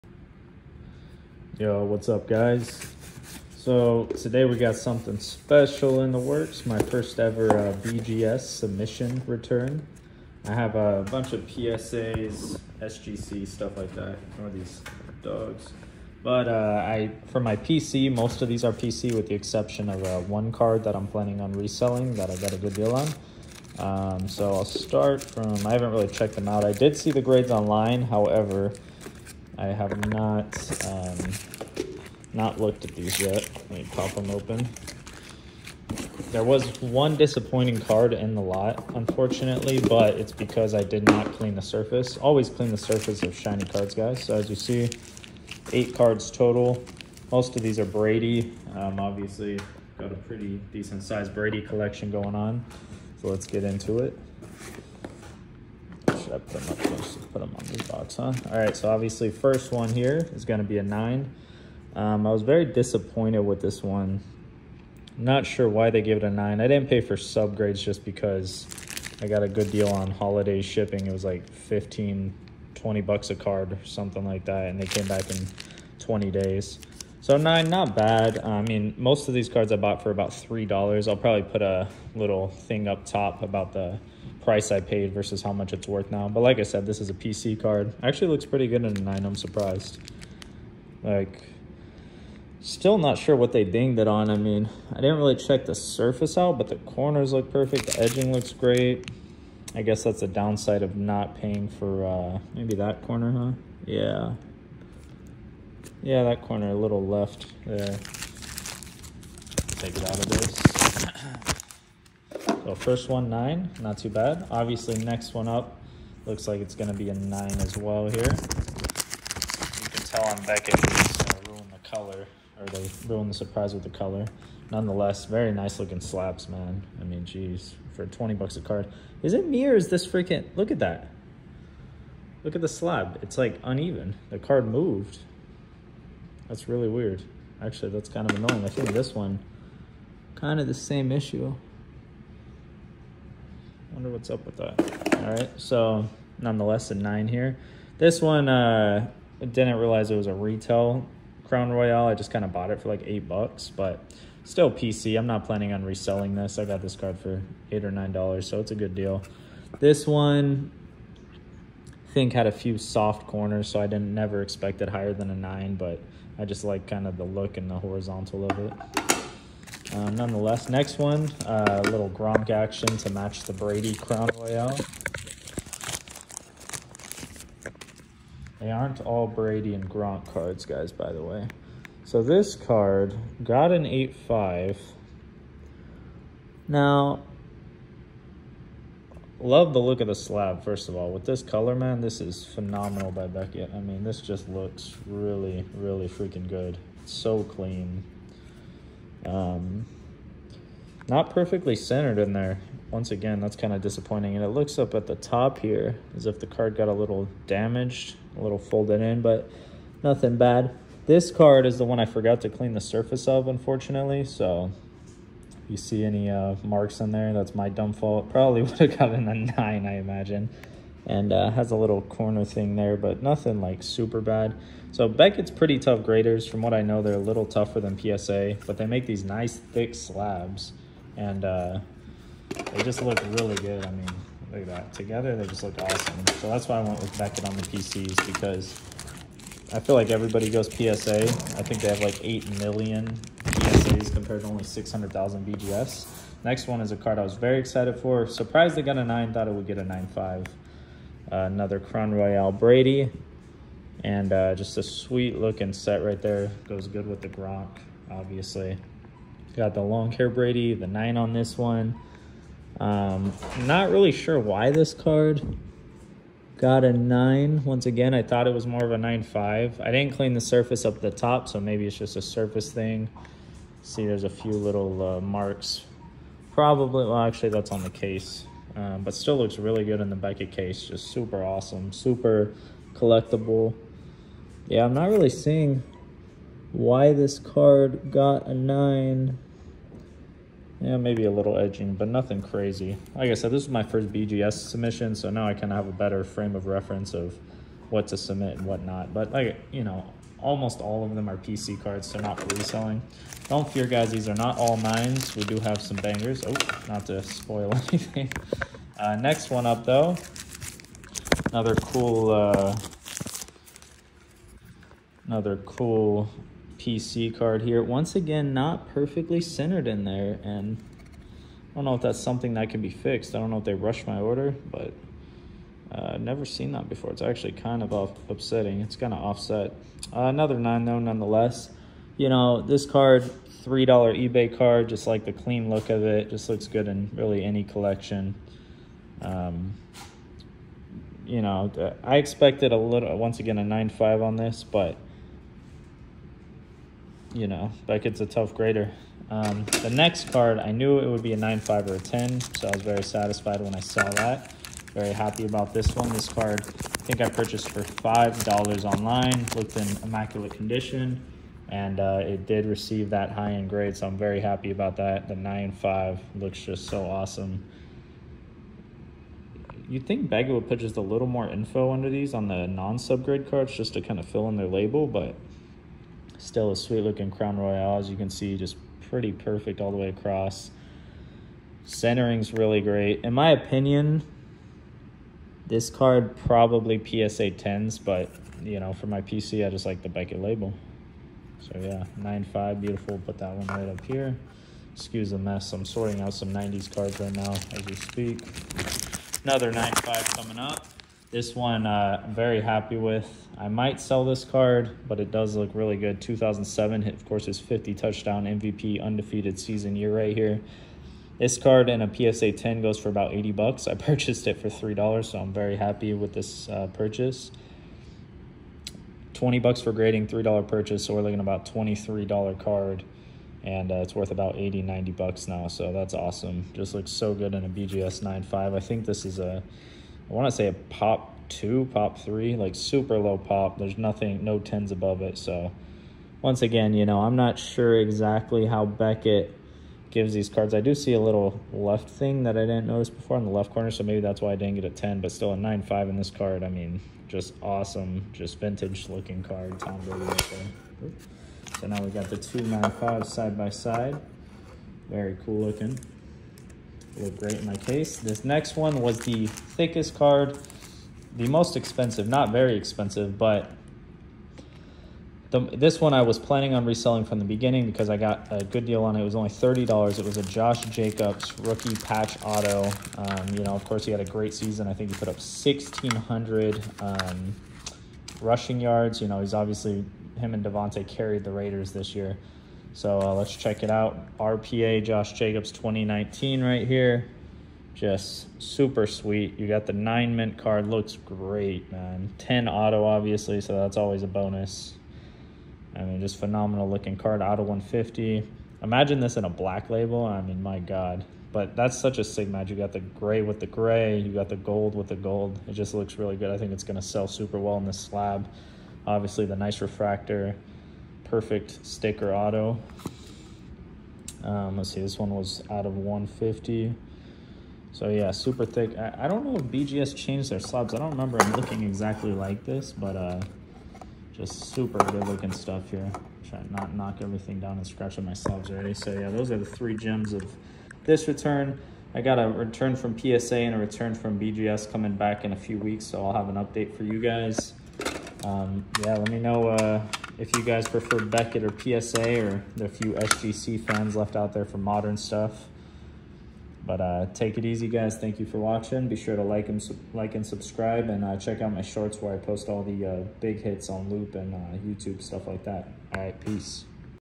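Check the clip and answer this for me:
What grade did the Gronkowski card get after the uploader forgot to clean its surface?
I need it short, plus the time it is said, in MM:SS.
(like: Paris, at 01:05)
8.5, at 03:03.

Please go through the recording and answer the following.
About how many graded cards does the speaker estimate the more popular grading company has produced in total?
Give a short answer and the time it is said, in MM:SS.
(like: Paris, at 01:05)
8 million, at 04:02.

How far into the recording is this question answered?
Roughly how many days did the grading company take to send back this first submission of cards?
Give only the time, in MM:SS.
01:15.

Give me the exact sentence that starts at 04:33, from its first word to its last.
See, there's a few little uh, marks.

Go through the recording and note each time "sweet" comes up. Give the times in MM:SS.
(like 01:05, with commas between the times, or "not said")
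04:14, 06:16, 08:09.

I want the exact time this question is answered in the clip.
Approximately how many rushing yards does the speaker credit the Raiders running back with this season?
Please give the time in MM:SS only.
07:55.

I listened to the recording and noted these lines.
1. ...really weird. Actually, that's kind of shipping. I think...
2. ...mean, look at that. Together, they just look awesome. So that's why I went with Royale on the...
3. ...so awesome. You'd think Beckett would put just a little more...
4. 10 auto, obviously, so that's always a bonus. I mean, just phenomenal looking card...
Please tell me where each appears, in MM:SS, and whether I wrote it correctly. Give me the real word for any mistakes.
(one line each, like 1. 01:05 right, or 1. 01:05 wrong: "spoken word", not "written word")
1. 02:16 wrong: "annoying", not "shipping"
2. 03:53 wrong: "Beckett", not "Royale"
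3. 06:06 right
4. 08:12 right.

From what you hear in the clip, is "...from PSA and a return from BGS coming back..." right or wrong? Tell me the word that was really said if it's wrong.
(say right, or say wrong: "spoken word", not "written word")
right.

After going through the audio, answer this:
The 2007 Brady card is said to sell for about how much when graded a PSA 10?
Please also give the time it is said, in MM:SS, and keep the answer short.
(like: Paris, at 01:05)
80 bucks, at 06:53.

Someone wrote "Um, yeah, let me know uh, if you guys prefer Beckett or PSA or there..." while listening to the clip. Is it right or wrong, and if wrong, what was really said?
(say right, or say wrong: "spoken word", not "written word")
right.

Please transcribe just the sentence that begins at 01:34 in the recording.
I mean, I didn't really check the surface out, but the corners look perfect.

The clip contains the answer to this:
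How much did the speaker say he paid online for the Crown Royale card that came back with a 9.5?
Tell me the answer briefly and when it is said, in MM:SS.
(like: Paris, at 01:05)
$5, at 05:57.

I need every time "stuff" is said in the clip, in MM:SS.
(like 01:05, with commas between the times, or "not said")
00:13, 08:45, 09:05, 09:15.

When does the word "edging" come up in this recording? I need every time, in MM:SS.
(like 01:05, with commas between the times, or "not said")
01:38, 04:51.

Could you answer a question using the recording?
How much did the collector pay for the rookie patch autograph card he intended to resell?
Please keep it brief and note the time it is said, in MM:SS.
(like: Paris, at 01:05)
$30, at 07:49.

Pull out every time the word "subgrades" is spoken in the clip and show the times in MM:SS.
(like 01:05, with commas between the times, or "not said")
01:07, 06:12.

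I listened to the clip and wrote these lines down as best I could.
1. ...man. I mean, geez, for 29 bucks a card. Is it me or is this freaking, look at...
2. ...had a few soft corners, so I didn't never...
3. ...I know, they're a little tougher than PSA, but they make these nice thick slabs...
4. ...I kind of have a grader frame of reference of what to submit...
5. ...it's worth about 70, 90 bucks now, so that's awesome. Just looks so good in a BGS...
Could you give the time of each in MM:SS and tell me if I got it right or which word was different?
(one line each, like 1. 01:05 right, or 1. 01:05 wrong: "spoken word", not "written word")
1. 02:06 wrong: "20", not "29"
2. 02:42 right
3. 03:46 right
4. 04:55 wrong: "better", not "grader"
5. 07:04 wrong: "80", not "70".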